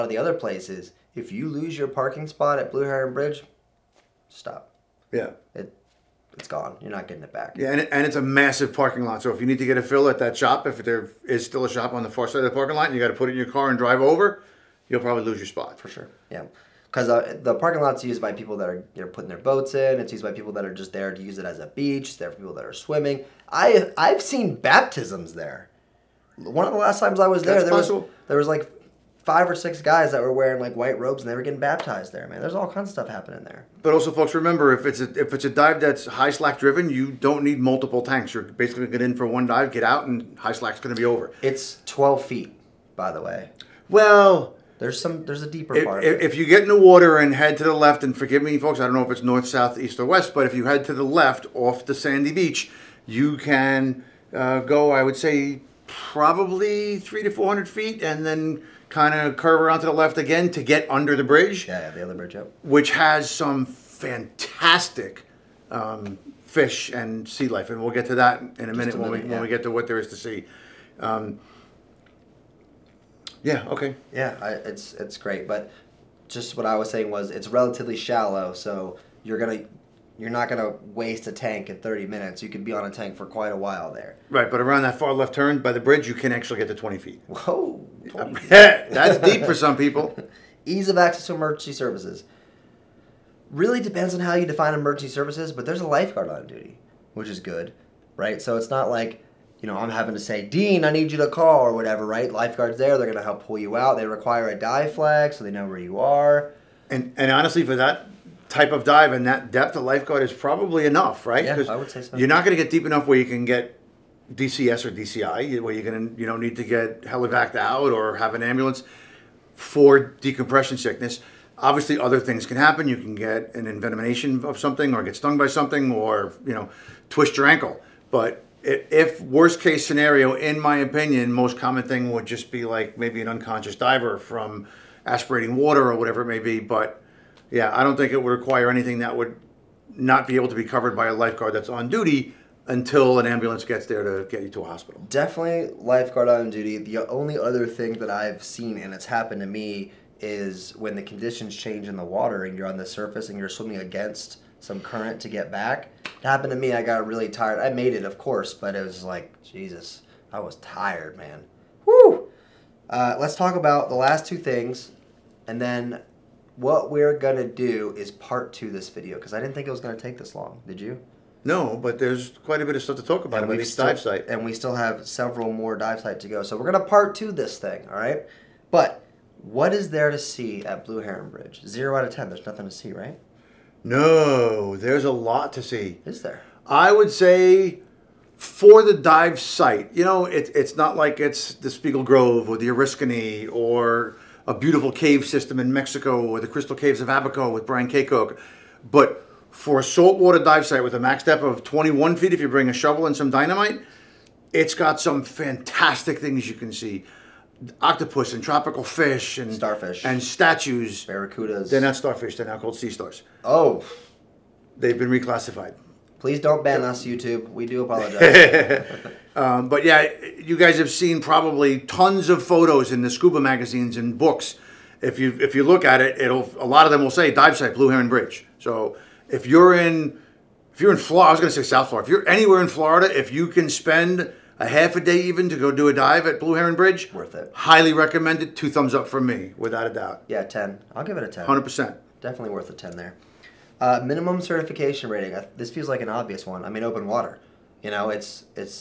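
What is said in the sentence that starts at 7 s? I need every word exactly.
Yeah, and, it, and it's a massive parking lot.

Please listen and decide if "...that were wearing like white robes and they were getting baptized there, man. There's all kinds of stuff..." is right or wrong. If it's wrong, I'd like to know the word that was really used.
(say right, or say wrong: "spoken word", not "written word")
right.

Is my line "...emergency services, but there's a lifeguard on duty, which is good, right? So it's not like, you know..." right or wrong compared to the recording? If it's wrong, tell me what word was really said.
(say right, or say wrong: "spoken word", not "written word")
right.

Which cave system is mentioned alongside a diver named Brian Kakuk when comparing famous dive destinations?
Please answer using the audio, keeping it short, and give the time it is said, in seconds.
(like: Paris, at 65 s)
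Crystal Caves of Abaco, at 196 s.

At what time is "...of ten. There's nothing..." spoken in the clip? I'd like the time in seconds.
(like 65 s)
182 s.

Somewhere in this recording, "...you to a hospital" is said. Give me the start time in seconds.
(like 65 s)
144 s.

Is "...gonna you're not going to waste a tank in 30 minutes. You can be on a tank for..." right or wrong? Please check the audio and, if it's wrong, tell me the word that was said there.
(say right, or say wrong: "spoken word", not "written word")
right.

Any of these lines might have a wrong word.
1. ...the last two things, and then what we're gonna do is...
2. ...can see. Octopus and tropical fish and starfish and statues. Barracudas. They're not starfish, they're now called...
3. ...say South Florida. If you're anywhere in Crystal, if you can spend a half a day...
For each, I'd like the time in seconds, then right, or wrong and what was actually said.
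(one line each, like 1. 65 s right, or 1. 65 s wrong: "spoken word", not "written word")
1. 163 s right
2. 206 s right
3. 231 s wrong: "Florida", not "Crystal".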